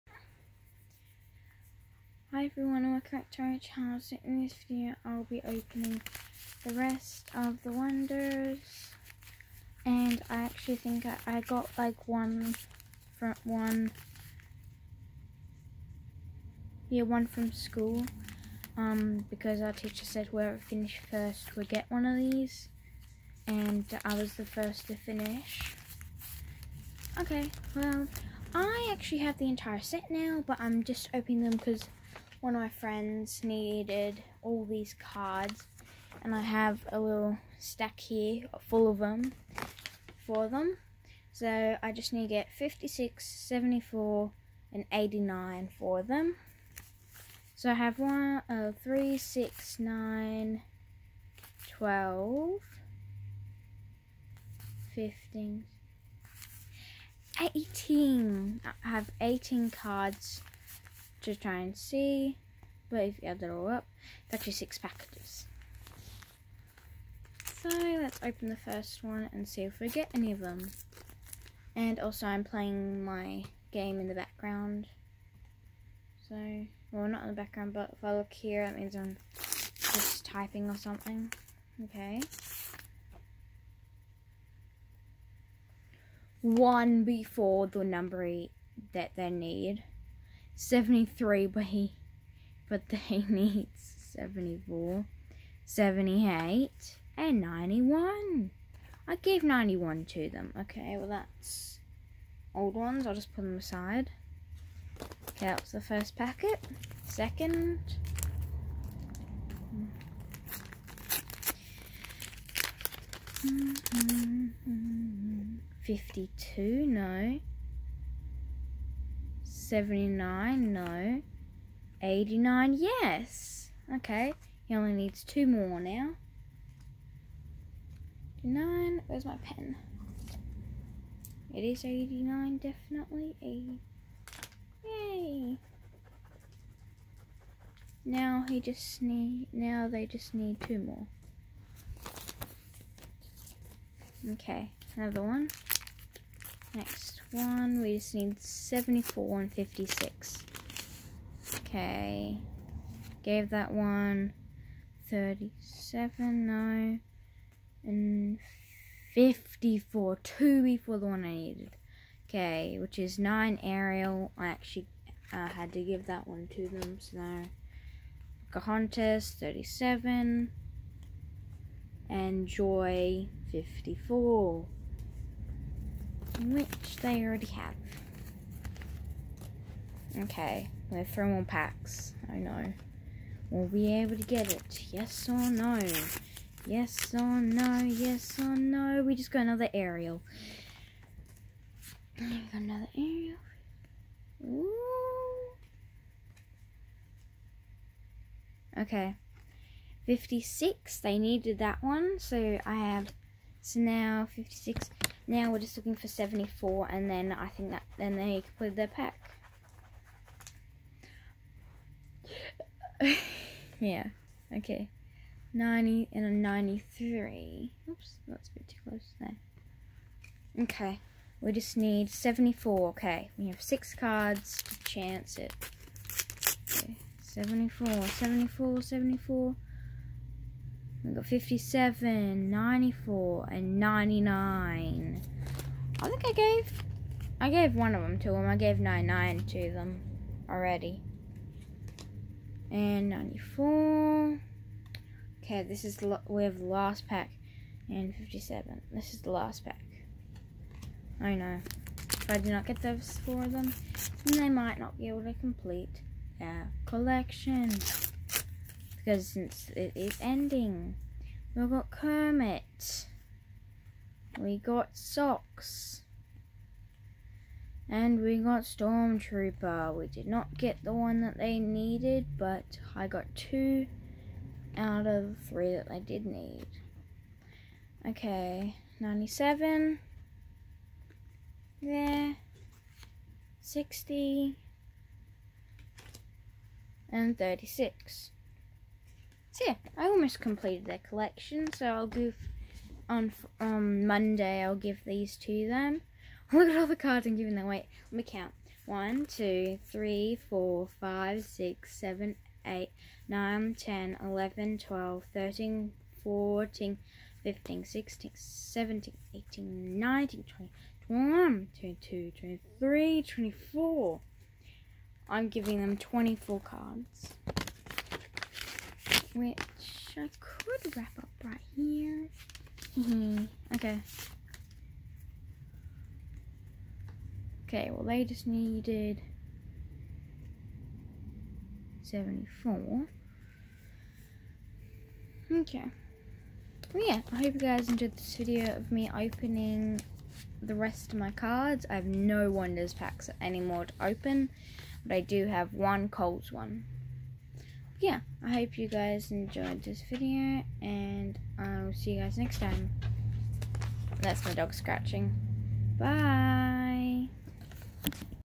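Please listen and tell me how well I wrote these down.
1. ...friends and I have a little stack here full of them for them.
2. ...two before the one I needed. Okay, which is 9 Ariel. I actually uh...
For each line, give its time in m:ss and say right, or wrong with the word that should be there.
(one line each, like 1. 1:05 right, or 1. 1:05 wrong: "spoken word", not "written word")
1. 0:34 wrong: "cards", not "friends"
2. 2:40 right.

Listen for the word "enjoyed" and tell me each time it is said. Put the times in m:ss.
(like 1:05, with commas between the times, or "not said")
5:37, 5:49.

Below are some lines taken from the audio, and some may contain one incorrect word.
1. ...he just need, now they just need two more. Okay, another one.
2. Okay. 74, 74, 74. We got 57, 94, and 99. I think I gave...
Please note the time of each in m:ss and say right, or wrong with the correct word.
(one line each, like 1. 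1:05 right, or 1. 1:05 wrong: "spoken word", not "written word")
1. 2:18 right
2. 3:46 right.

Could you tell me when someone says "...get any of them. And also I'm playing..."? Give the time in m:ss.
1:09.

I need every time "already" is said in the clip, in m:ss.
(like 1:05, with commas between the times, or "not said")
2:57, 4:00.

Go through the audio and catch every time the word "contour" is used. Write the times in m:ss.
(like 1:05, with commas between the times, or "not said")
not said.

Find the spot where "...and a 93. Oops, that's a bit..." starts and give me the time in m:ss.
3:36.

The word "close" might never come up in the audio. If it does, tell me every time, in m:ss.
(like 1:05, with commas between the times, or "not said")
3:38.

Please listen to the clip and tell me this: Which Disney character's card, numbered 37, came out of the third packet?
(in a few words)
Pocahontas.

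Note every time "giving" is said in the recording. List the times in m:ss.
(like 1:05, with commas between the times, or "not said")
4:57, 5:15.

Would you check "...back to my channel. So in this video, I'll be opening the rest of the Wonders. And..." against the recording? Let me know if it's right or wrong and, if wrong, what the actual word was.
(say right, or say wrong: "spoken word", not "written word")
right.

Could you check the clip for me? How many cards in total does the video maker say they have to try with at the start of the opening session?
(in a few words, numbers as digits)
18.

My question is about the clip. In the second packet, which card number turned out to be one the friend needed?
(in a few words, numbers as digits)
89.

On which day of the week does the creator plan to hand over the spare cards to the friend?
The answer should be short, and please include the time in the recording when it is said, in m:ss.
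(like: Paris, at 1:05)
Monday, at 4:54.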